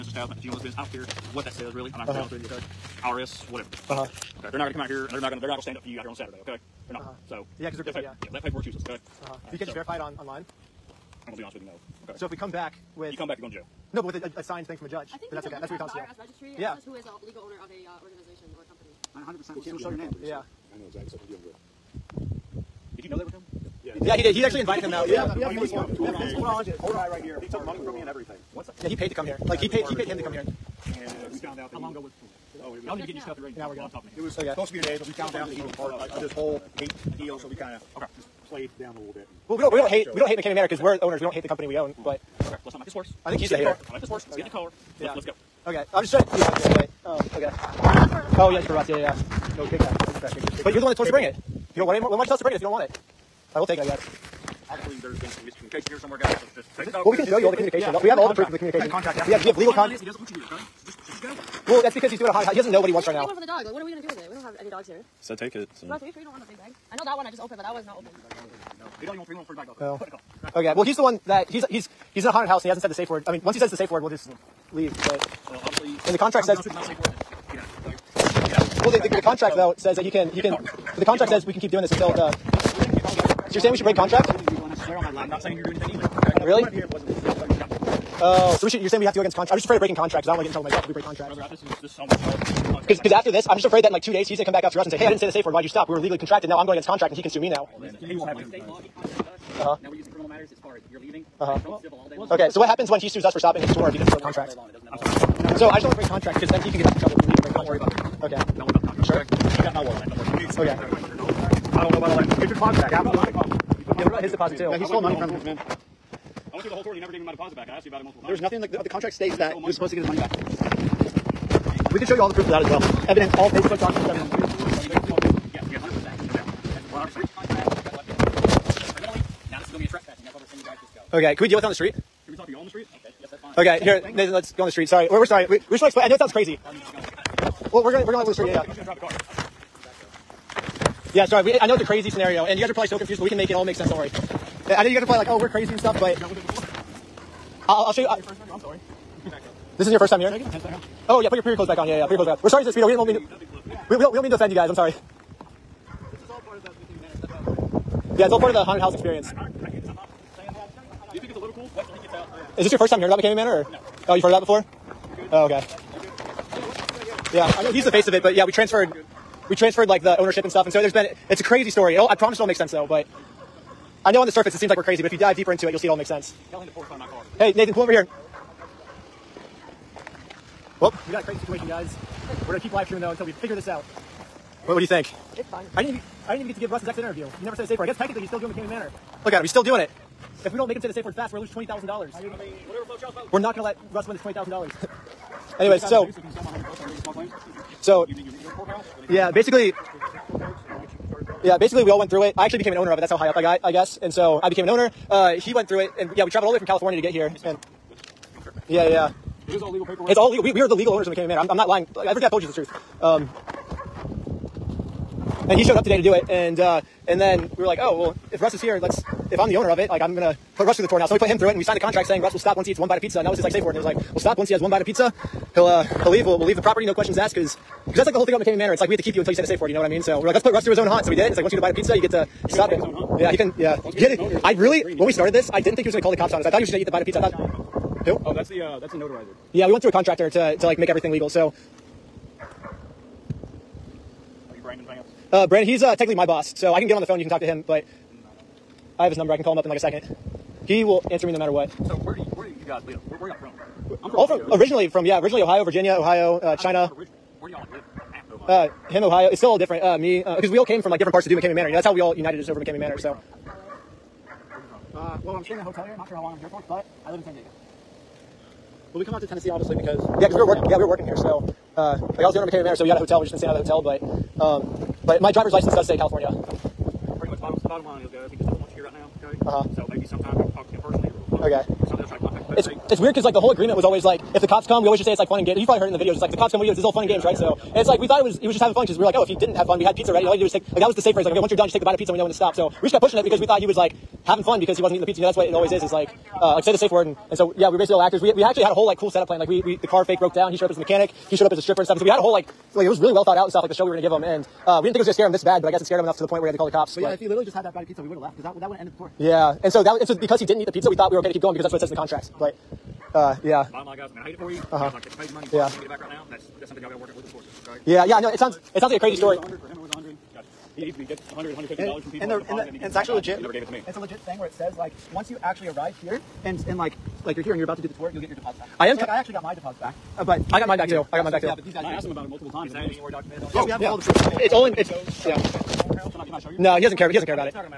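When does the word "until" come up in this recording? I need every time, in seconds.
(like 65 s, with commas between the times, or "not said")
81 s, 183 s, 229 s.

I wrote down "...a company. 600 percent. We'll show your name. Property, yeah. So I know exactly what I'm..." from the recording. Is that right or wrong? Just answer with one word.
wrong.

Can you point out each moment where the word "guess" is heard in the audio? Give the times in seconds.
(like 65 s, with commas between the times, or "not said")
53 s, 187 s, 203 s, 305 s.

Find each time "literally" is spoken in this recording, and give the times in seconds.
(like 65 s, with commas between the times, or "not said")
307 s.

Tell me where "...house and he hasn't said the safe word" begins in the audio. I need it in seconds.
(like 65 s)
72 s.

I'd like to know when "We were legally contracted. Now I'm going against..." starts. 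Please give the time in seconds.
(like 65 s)
95 s.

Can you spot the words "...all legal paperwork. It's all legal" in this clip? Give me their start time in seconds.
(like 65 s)
209 s.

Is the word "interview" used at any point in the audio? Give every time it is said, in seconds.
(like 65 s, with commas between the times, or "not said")
187 s.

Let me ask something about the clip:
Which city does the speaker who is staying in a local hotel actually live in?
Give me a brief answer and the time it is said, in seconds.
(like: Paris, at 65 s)
San Diego, at 267 s.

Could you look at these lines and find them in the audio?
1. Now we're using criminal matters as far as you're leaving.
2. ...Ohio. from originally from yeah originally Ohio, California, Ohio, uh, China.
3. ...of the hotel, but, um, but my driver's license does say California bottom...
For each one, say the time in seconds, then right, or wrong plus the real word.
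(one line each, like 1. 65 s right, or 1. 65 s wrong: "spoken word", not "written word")
1. 99 s right
2. 254 s wrong: "Virginia", not "California"
3. 273 s right.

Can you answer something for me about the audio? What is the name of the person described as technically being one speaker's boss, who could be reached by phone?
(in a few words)
Brandon.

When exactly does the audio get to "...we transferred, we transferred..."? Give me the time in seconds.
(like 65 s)
168 s.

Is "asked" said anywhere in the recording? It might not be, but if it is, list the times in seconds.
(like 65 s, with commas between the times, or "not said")
117 s, 227 s, 331 s.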